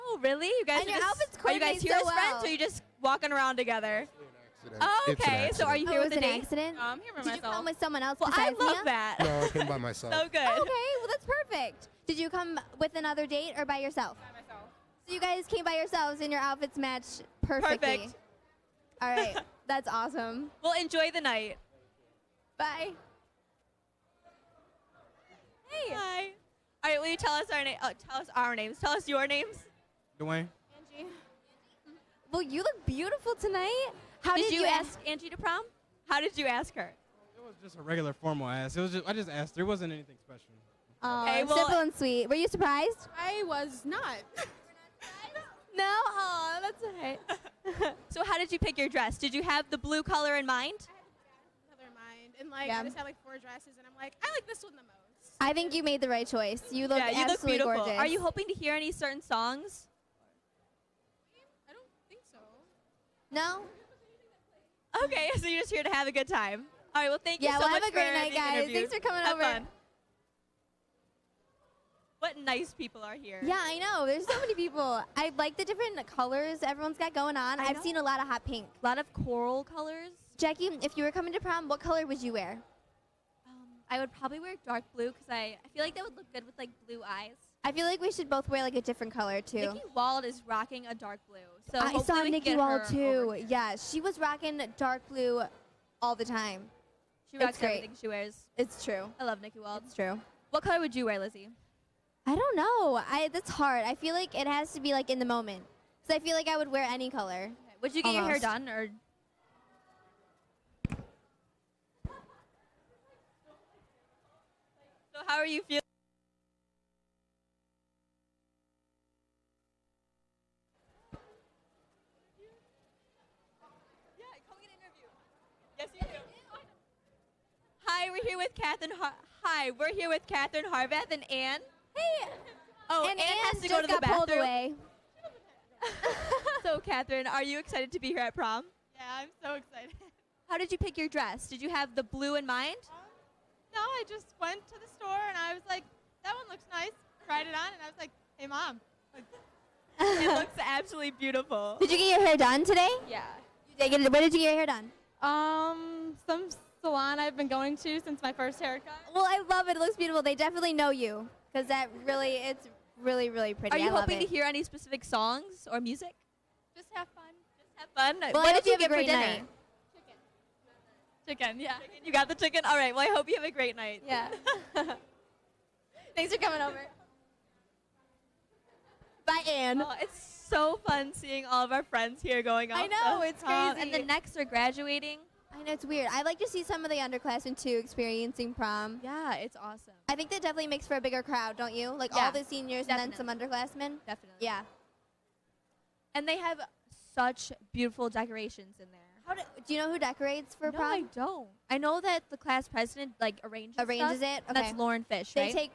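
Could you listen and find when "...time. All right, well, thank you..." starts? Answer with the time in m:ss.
1:06.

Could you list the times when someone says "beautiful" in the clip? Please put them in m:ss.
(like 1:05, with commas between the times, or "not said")
0:32, 0:57, 2:31, 2:39, 3:17.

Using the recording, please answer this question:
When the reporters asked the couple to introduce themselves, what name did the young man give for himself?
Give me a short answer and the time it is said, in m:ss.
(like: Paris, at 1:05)
Dwayne, at 0:30.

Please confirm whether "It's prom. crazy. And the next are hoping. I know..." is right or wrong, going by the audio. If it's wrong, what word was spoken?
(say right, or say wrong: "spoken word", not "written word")
wrong: "graduating", not "hoping".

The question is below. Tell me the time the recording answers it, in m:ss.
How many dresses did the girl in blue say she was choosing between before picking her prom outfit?
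0:53.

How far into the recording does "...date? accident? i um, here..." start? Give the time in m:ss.
0:06.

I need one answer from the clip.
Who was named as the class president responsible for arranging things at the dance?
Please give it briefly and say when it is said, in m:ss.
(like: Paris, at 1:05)
Lauren Fish, at 3:24.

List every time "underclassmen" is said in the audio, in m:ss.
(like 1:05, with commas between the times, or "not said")
3:06, 3:13.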